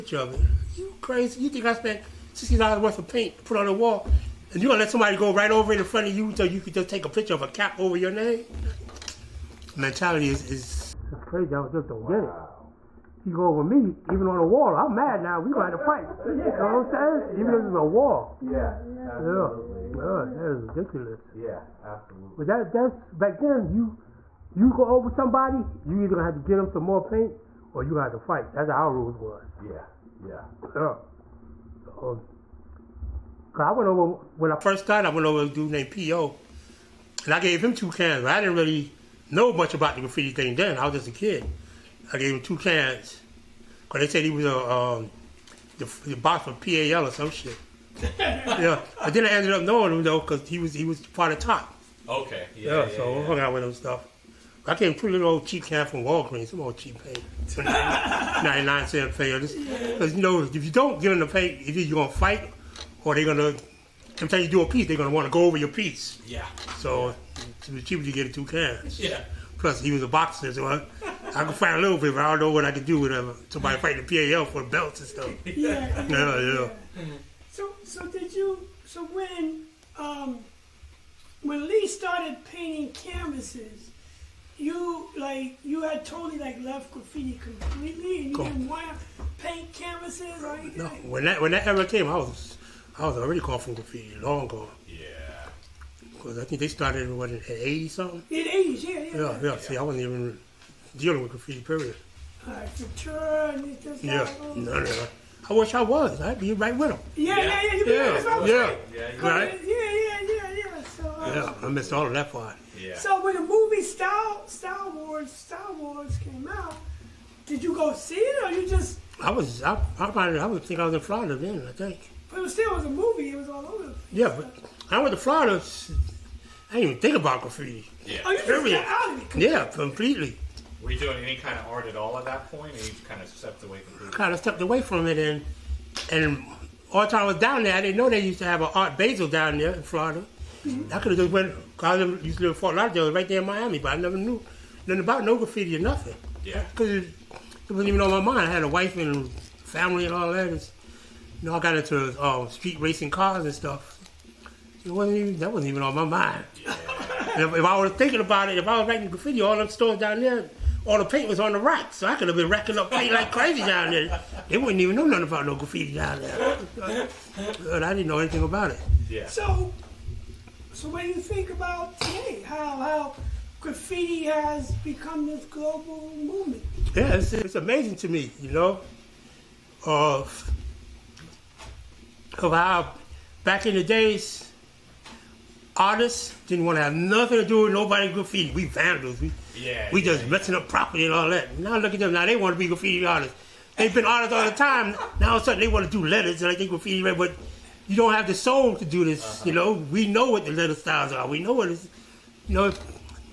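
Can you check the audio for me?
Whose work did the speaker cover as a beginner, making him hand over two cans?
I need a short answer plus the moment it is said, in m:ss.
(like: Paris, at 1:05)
P.O., at 0:35.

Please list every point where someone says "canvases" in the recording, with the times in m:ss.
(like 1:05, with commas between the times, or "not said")
1:22, 1:29.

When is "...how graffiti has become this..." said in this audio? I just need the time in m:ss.
2:52.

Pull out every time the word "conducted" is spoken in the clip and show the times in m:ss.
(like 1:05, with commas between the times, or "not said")
not said.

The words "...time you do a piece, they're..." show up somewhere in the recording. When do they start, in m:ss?
1:04.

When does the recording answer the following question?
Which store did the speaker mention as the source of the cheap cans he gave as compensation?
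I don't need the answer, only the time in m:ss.
0:56.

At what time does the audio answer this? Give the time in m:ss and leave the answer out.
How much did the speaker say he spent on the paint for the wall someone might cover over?
0:02.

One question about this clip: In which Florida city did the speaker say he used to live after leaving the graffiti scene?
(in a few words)
Fort Lauderdale.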